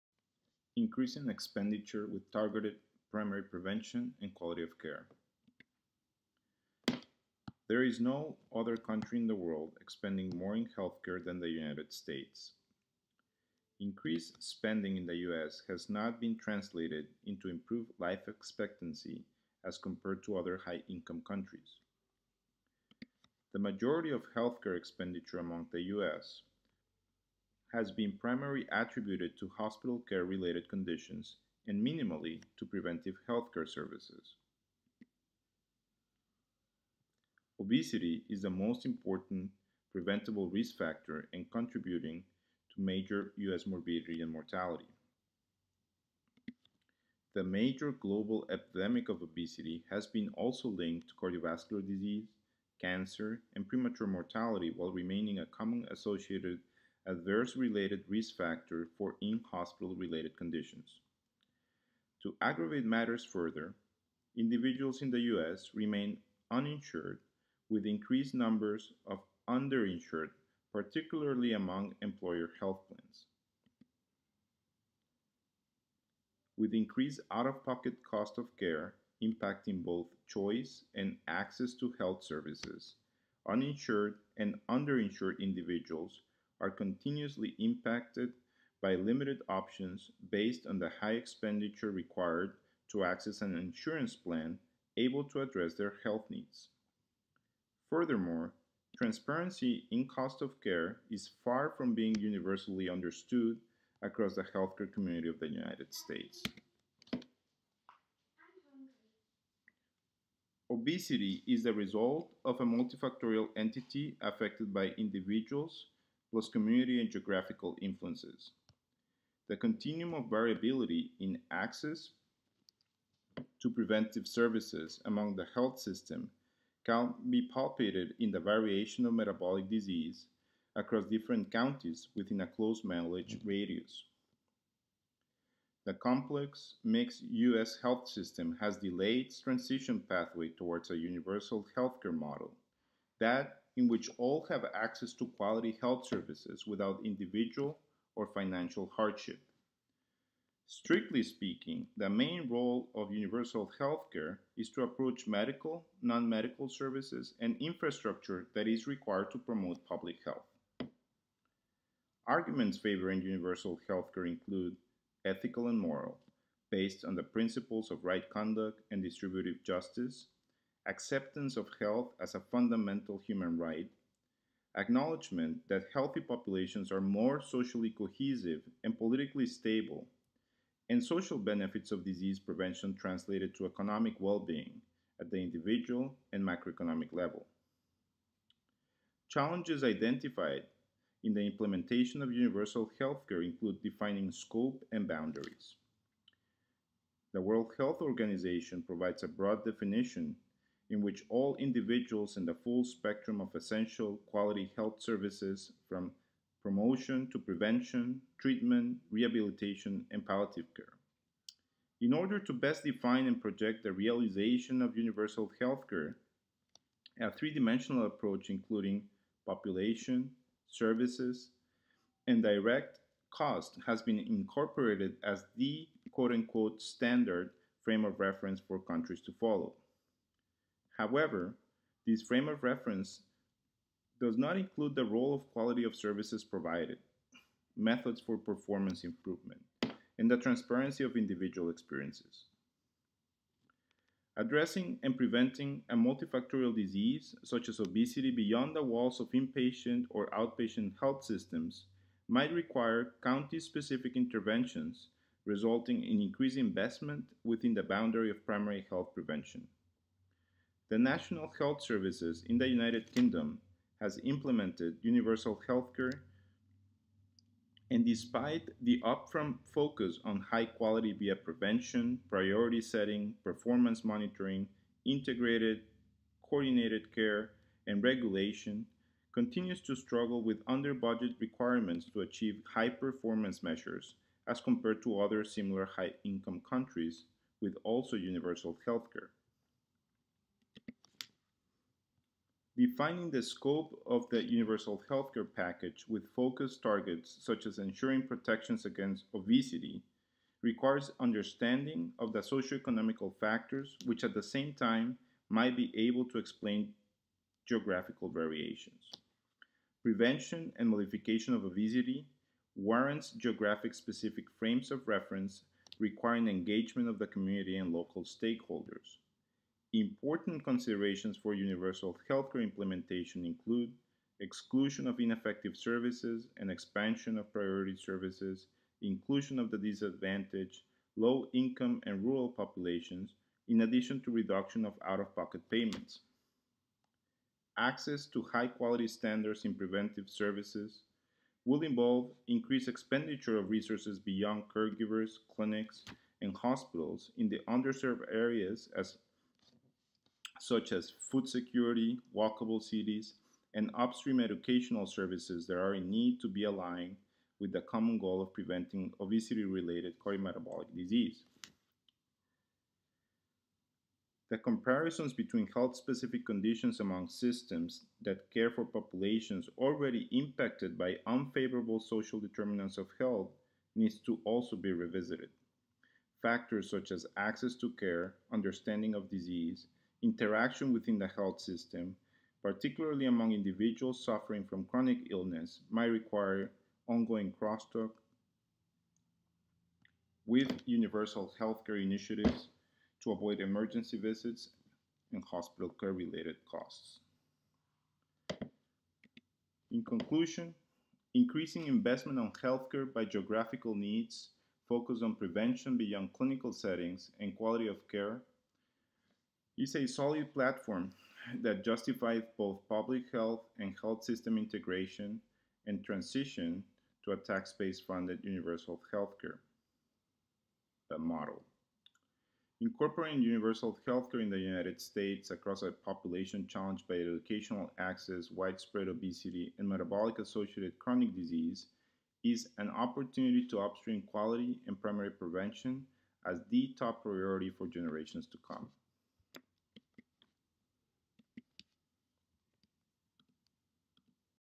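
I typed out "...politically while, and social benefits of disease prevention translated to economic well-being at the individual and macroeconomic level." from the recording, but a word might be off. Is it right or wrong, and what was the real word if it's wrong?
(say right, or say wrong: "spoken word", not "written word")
wrong: "stable", not "while".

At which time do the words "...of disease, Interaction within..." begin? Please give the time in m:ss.
6:19.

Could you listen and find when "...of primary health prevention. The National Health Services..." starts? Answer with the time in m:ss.
4:18.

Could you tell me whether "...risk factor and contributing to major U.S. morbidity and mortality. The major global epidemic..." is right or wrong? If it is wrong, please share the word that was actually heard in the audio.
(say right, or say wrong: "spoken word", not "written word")
right.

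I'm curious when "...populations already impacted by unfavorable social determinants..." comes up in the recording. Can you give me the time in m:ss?
6:08.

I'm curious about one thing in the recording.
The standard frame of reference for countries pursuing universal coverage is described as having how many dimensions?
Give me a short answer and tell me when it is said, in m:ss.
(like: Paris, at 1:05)
3, at 3:37.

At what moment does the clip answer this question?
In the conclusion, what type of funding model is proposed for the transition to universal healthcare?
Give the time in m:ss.
6:57.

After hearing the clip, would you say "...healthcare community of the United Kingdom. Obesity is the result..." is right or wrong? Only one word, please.
wrong.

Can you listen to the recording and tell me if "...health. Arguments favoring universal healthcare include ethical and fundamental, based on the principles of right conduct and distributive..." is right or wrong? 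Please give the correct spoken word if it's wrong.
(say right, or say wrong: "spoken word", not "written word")
wrong: "moral", not "fundamental".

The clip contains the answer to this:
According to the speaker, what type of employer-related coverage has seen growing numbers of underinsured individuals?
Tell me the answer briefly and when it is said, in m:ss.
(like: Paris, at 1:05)
Employer health plans, at 1:12.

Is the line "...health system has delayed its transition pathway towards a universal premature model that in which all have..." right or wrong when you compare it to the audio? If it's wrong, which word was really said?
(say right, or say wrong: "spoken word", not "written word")
wrong: "healthcare", not "premature".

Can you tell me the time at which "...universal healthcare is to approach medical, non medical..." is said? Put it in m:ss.
2:33.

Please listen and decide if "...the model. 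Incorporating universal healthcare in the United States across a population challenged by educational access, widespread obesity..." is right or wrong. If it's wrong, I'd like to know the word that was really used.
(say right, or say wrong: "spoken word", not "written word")
right.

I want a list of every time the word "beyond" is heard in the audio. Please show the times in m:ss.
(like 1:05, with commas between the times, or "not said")
4:08, 5:44, 6:45.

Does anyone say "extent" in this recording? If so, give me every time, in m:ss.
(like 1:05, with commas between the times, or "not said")
not said.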